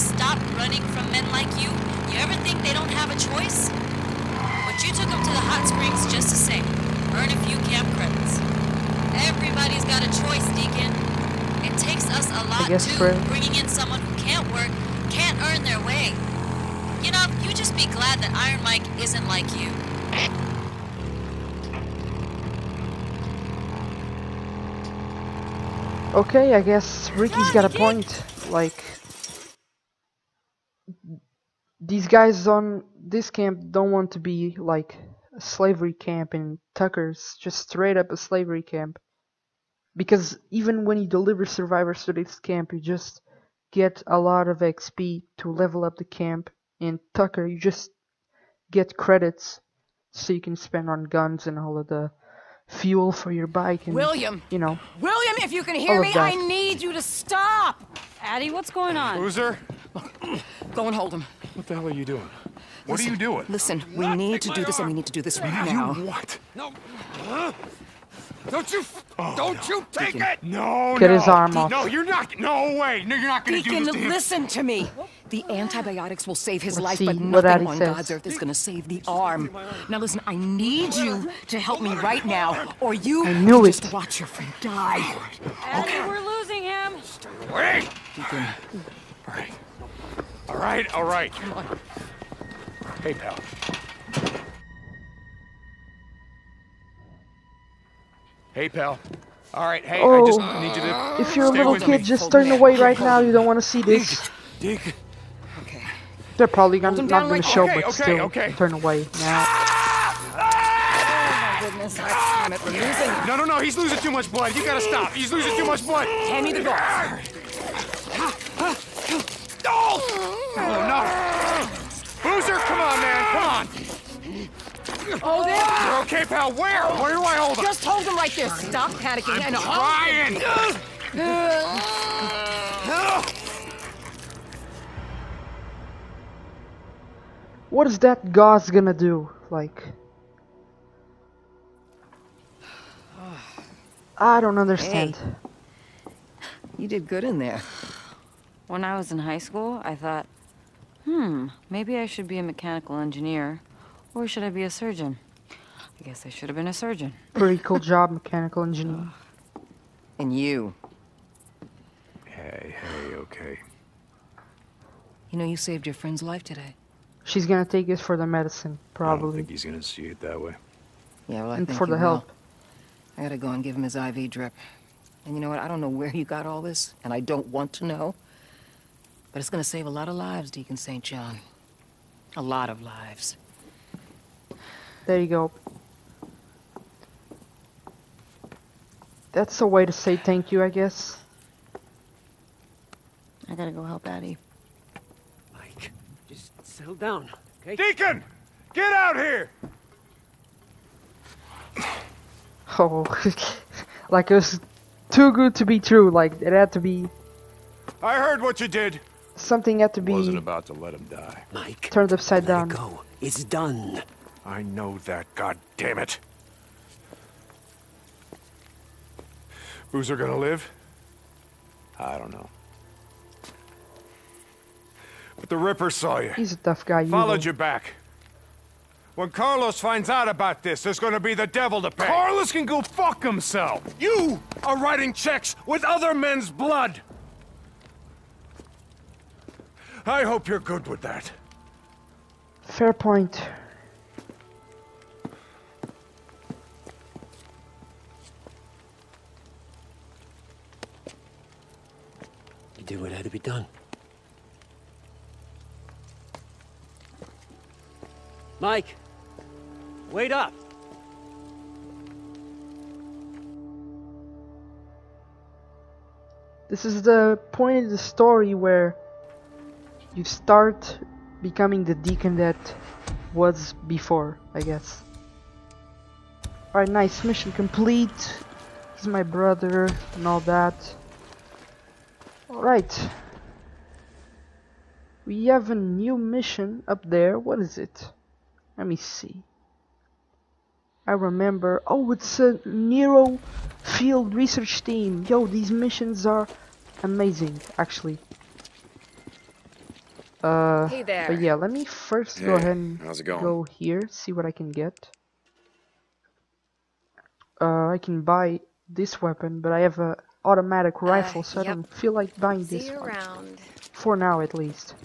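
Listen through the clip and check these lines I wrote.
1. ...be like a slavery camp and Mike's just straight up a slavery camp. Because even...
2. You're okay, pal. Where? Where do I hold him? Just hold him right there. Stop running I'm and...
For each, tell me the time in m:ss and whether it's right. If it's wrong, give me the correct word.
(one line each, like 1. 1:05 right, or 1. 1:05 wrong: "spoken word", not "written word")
1. 0:34 wrong: "Tucker", not "Mike"
2. 2:05 wrong: "panicking", not "running".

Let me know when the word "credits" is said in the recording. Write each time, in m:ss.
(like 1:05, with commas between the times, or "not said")
0:07, 0:48.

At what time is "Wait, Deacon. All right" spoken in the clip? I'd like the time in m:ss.
1:27.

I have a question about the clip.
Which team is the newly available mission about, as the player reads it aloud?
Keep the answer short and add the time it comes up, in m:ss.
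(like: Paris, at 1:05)
NERO field research team, at 4:52.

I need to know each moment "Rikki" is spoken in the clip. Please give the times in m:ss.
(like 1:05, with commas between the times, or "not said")
0:27.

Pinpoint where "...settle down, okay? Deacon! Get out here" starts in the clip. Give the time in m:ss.
3:16.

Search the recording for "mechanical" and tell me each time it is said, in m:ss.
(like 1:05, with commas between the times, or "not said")
2:32, 2:38.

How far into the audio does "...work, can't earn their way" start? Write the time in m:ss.
0:14.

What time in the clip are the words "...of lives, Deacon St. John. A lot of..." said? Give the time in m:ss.
3:00.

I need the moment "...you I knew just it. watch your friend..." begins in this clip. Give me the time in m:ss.
1:22.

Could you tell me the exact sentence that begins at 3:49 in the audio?
When Carlos finds out about this, there's gonna be the devil to pay.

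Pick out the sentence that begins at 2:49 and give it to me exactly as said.
I don't think he's gonna see it that way.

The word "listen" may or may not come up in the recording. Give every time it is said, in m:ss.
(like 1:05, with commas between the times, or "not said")
1:03, 1:14, 1:19.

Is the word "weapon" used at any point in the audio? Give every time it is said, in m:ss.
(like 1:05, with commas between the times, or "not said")
5:09.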